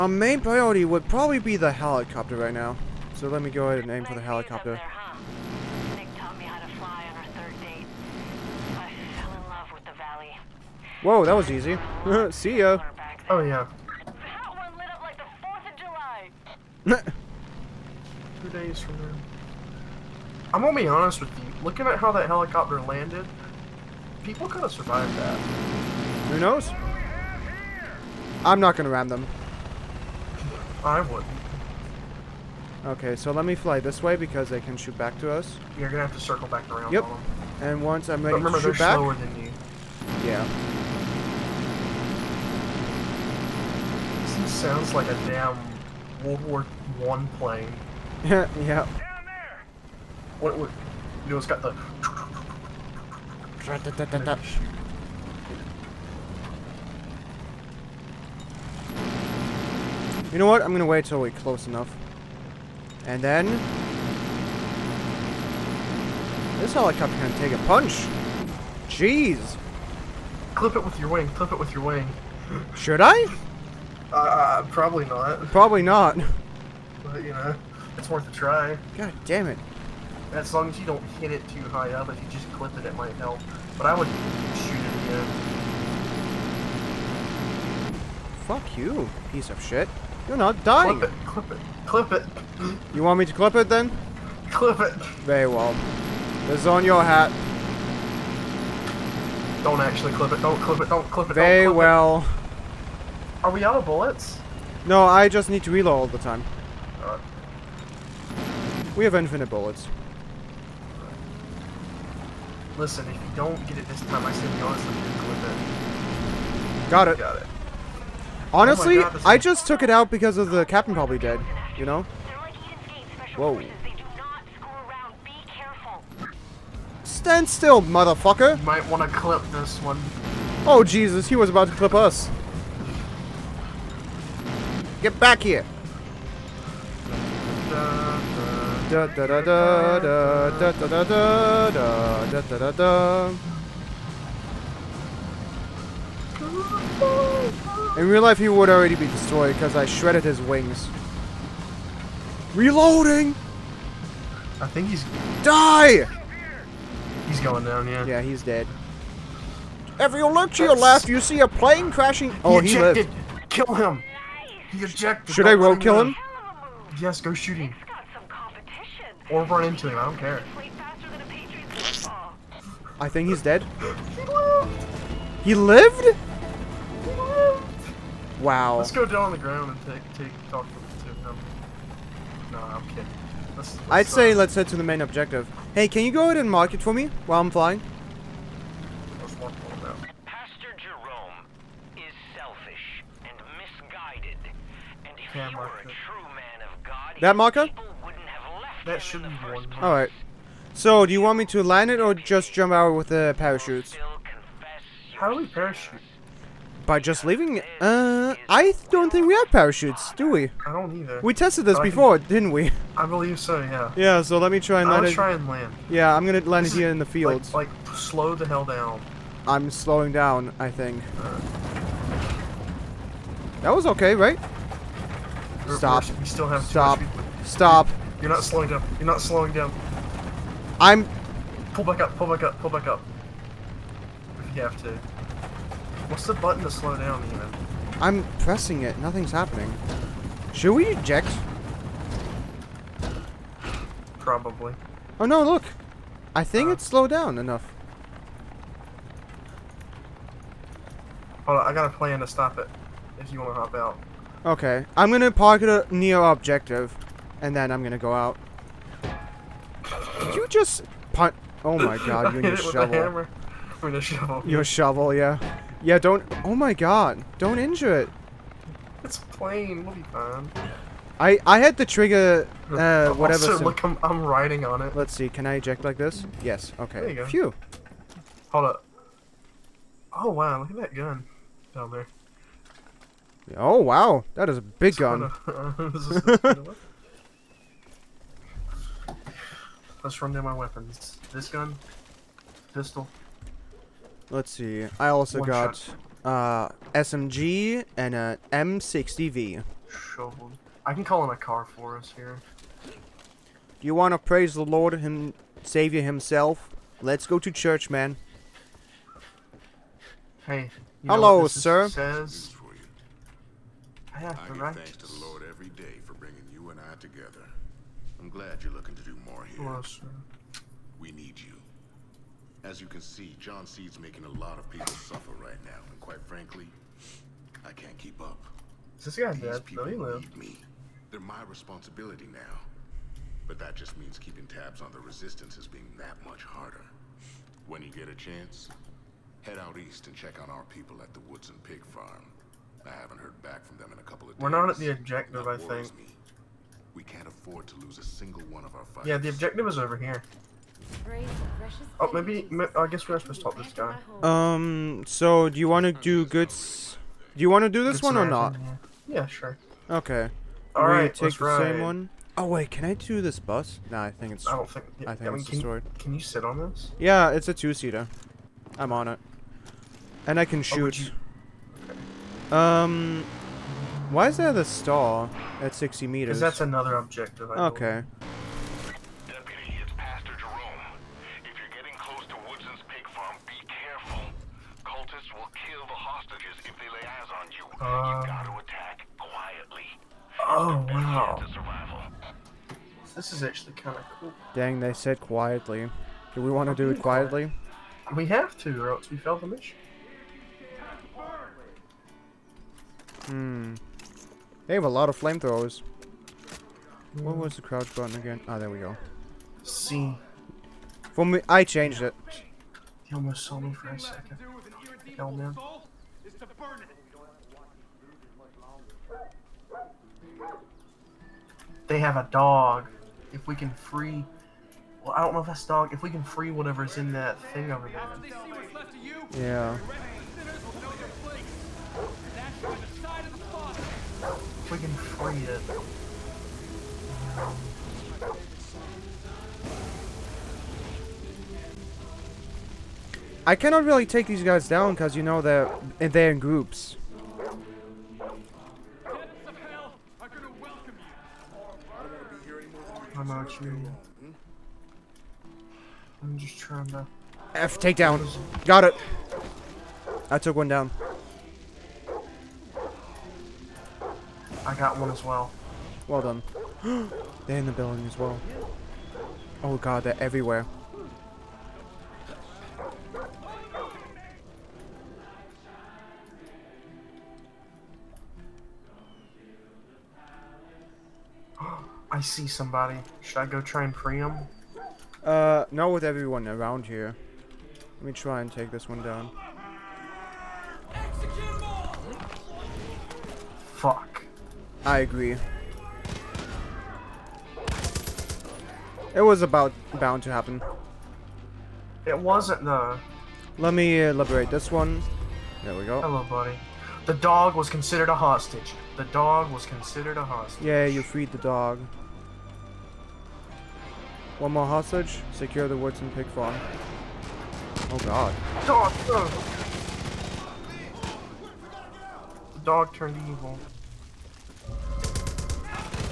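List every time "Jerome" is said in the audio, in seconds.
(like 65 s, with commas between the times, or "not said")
190 s, 380 s.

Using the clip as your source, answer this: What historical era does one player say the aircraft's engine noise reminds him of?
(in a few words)
World War One.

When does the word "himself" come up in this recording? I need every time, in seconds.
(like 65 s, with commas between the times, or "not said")
306 s.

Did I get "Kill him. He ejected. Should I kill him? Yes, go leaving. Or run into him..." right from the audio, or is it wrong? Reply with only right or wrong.
wrong.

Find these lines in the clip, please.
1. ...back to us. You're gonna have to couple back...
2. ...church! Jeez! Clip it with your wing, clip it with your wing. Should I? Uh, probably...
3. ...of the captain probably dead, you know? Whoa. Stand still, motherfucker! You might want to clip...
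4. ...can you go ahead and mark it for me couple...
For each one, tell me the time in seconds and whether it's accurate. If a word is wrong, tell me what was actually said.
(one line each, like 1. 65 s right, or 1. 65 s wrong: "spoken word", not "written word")
1. 34 s wrong: "circle", not "couple"
2. 67 s wrong: "punch", not "church"
3. 120 s right
4. 185 s wrong: "while", not "couple".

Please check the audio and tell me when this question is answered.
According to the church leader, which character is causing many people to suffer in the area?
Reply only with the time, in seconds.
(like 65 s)
323 s.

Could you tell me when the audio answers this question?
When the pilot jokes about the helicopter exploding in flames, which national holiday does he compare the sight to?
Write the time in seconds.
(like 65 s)
15 s.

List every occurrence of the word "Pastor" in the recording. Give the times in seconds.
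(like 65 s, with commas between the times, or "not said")
190 s, 379 s.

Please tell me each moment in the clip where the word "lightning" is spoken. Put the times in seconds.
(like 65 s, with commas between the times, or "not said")
not said.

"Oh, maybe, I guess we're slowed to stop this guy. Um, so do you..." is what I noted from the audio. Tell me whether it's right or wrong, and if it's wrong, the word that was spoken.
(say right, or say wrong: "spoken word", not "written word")
wrong: "supposed", not "slowed".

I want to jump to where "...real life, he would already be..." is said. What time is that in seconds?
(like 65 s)
148 s.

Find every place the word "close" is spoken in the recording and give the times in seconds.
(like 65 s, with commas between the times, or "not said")
61 s, 381 s.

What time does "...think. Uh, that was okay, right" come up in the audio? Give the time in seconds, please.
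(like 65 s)
220 s.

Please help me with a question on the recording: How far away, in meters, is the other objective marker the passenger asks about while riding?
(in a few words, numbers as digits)
60.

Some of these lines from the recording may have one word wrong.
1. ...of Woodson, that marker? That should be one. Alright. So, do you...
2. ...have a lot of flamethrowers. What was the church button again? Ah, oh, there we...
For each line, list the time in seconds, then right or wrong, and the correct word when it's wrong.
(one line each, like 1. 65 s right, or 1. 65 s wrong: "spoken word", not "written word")
1. 196 s wrong: "God", not "Woodson"
2. 404 s wrong: "crouch", not "church".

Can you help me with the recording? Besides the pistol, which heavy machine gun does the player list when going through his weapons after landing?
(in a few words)
M60.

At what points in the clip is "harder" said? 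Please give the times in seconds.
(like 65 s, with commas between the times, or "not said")
336 s.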